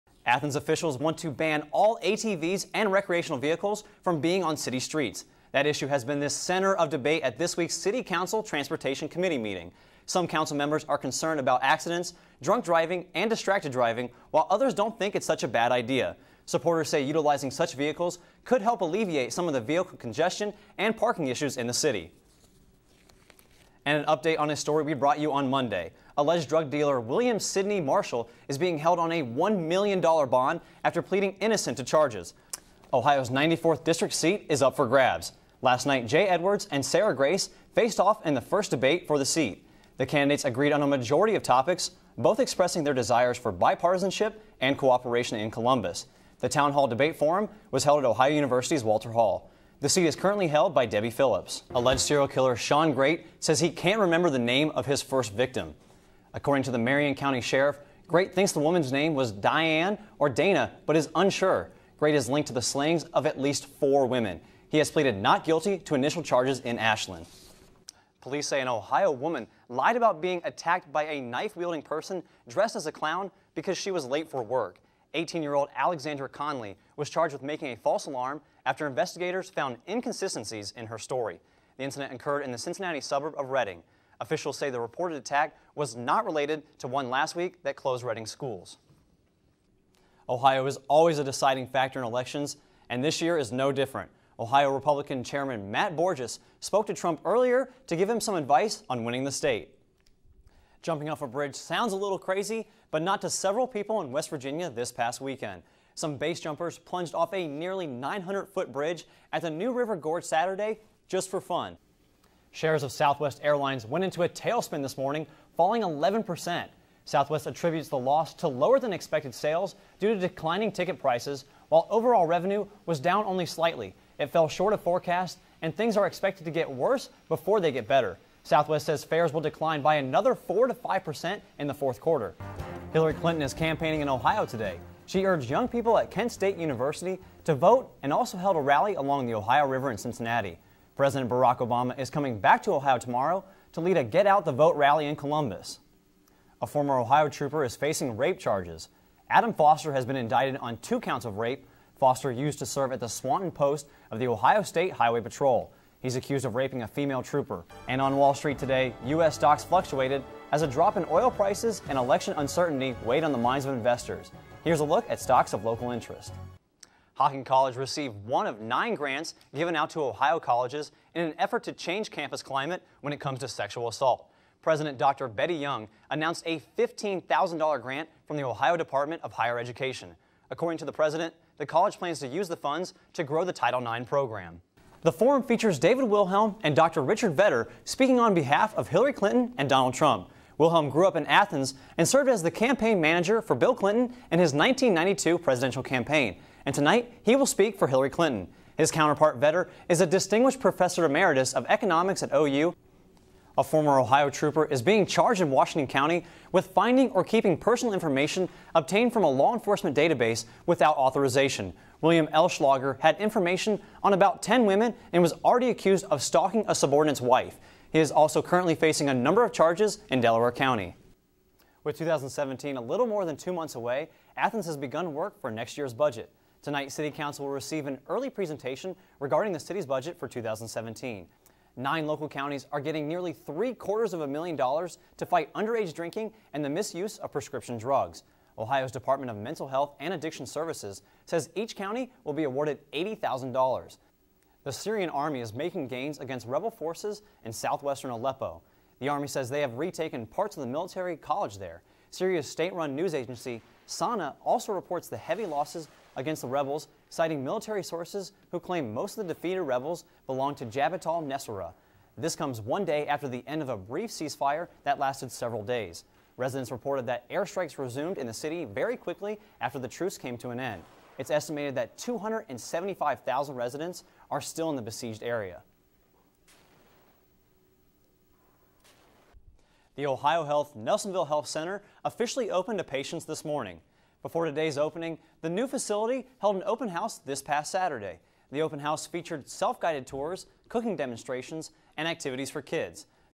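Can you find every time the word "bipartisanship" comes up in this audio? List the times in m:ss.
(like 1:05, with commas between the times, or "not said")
0:43.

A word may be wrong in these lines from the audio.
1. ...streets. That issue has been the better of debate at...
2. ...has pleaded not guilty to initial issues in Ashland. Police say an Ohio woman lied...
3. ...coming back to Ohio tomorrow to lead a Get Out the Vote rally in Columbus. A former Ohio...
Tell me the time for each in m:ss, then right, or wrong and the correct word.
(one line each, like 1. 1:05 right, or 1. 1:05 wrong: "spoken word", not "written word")
1. 0:04 wrong: "center", not "better"
2. 1:04 wrong: "charges", not "issues"
3. 2:22 right.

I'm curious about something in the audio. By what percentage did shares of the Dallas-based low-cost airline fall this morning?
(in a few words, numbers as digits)
11%.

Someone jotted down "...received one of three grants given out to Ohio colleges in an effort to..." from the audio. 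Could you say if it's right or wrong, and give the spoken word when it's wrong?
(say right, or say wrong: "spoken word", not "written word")
wrong: "nine", not "three".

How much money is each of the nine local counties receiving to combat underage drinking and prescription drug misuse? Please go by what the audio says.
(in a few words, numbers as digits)
$80,000.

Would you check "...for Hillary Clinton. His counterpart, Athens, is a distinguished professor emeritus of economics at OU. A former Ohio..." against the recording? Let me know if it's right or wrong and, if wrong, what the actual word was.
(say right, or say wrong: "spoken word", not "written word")
wrong: "Vedder", not "Athens".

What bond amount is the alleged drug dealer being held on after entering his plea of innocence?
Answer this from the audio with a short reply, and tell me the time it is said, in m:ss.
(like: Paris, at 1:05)
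$1 million, at 0:29.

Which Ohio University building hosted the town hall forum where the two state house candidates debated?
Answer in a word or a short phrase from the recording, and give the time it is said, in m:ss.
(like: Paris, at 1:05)
Walter Hall, at 0:48.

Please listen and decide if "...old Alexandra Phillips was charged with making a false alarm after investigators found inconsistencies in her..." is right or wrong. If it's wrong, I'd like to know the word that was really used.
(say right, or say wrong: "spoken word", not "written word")
wrong: "Conley", not "Phillips".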